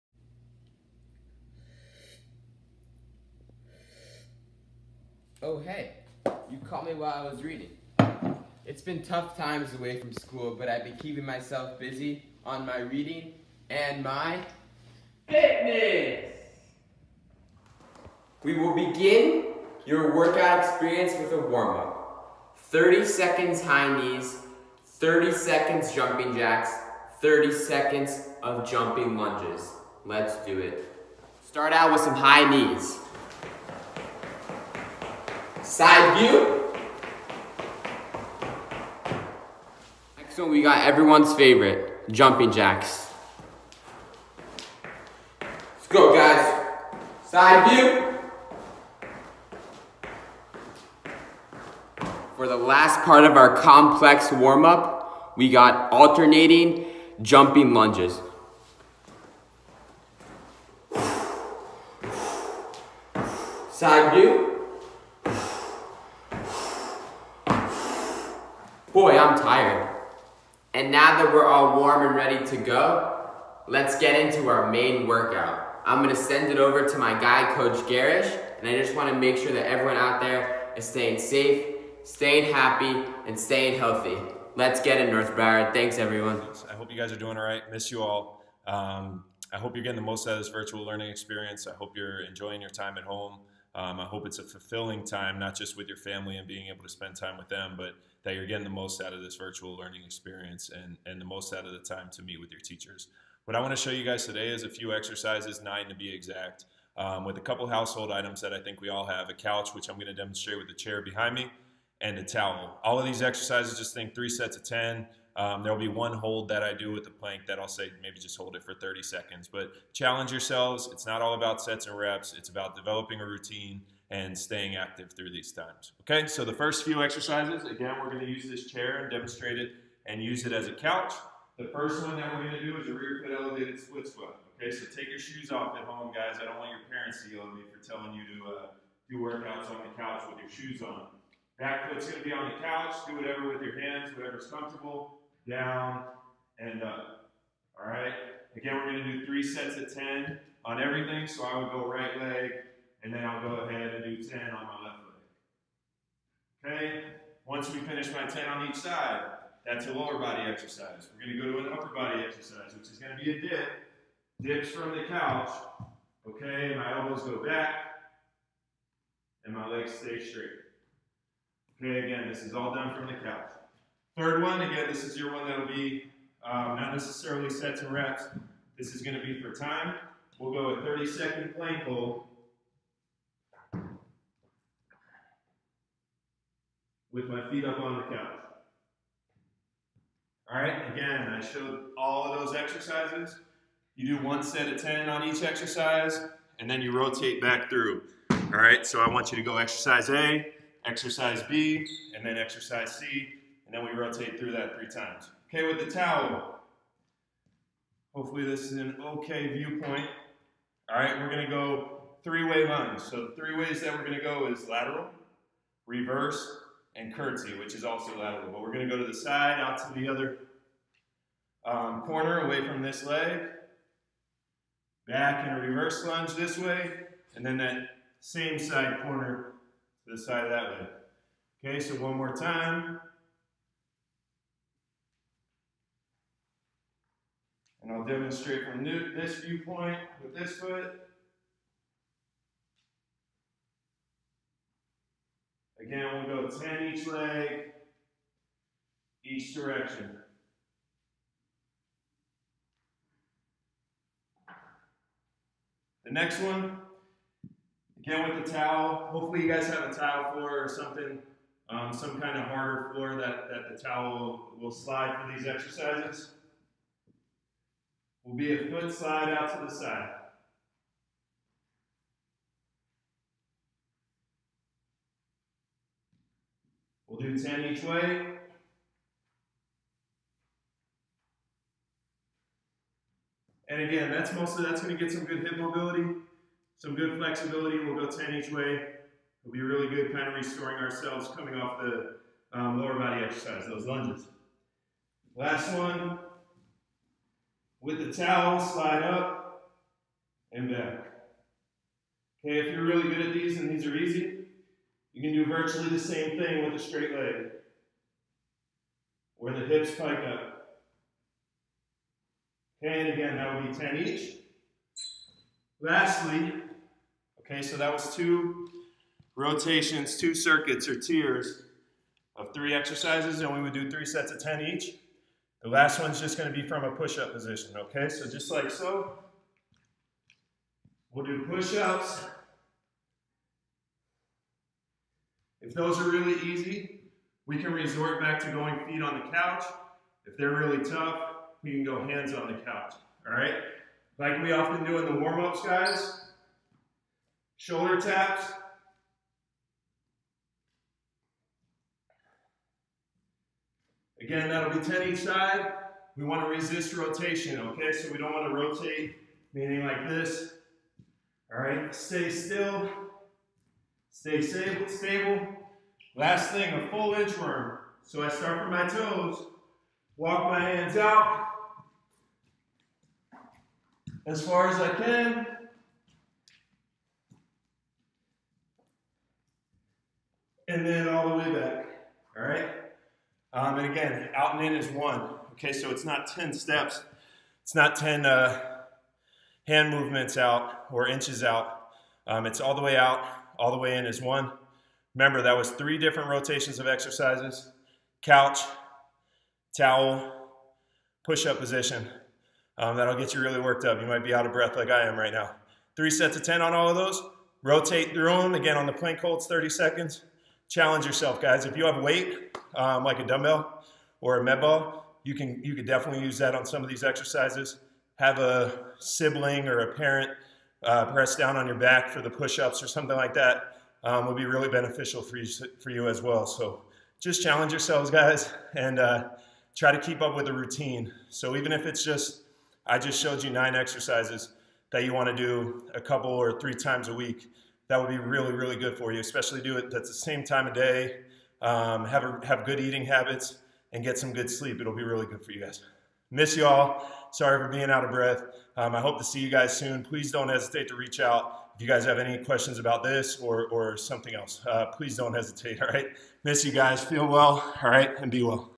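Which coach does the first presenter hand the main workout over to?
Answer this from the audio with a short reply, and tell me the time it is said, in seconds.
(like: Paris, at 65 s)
Coach Garrish, at 77 s.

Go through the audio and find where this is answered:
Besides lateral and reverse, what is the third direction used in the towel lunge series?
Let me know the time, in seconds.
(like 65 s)
217 s.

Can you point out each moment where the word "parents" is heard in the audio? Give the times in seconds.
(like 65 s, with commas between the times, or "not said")
136 s, 419 s.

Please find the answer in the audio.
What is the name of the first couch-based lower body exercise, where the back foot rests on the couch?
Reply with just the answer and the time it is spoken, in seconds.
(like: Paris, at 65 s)
Rear foot elevated split squat, at 132 s.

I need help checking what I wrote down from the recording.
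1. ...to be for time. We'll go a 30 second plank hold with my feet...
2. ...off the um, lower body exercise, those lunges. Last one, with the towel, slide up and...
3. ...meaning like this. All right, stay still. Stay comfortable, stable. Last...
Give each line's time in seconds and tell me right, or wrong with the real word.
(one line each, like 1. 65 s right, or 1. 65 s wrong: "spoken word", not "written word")
1. 179 s right
2. 291 s right
3. 359 s wrong: "stable", not "comfortable".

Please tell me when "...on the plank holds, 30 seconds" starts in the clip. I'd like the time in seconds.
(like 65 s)
408 s.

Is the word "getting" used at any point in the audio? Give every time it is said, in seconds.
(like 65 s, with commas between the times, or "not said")
89 s, 98 s.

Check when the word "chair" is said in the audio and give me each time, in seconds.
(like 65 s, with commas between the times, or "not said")
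110 s, 128 s.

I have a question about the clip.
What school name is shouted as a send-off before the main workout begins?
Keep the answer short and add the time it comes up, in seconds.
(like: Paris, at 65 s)
North Broward, at 85 s.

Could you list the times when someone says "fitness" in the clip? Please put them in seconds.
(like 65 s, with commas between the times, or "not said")
15 s.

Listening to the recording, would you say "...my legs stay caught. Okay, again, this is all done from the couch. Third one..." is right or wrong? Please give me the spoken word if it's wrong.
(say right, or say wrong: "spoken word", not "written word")
wrong: "straight", not "caught".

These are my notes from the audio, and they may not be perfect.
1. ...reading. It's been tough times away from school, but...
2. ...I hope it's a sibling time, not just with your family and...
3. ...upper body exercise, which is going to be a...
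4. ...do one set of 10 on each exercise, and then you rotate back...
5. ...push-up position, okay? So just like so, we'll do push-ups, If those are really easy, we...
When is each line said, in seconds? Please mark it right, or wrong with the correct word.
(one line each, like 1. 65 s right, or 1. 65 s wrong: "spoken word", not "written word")
1. 7 s right
2. 94 s wrong: "fulfilling", not "sibling"
3. 161 s right
4. 194 s right
5. 326 s right.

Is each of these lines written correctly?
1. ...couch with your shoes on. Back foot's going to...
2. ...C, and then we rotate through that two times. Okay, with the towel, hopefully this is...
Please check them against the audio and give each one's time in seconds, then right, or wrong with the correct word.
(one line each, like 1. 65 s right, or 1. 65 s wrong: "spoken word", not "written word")
1. 139 s right
2. 202 s wrong: "three", not "two".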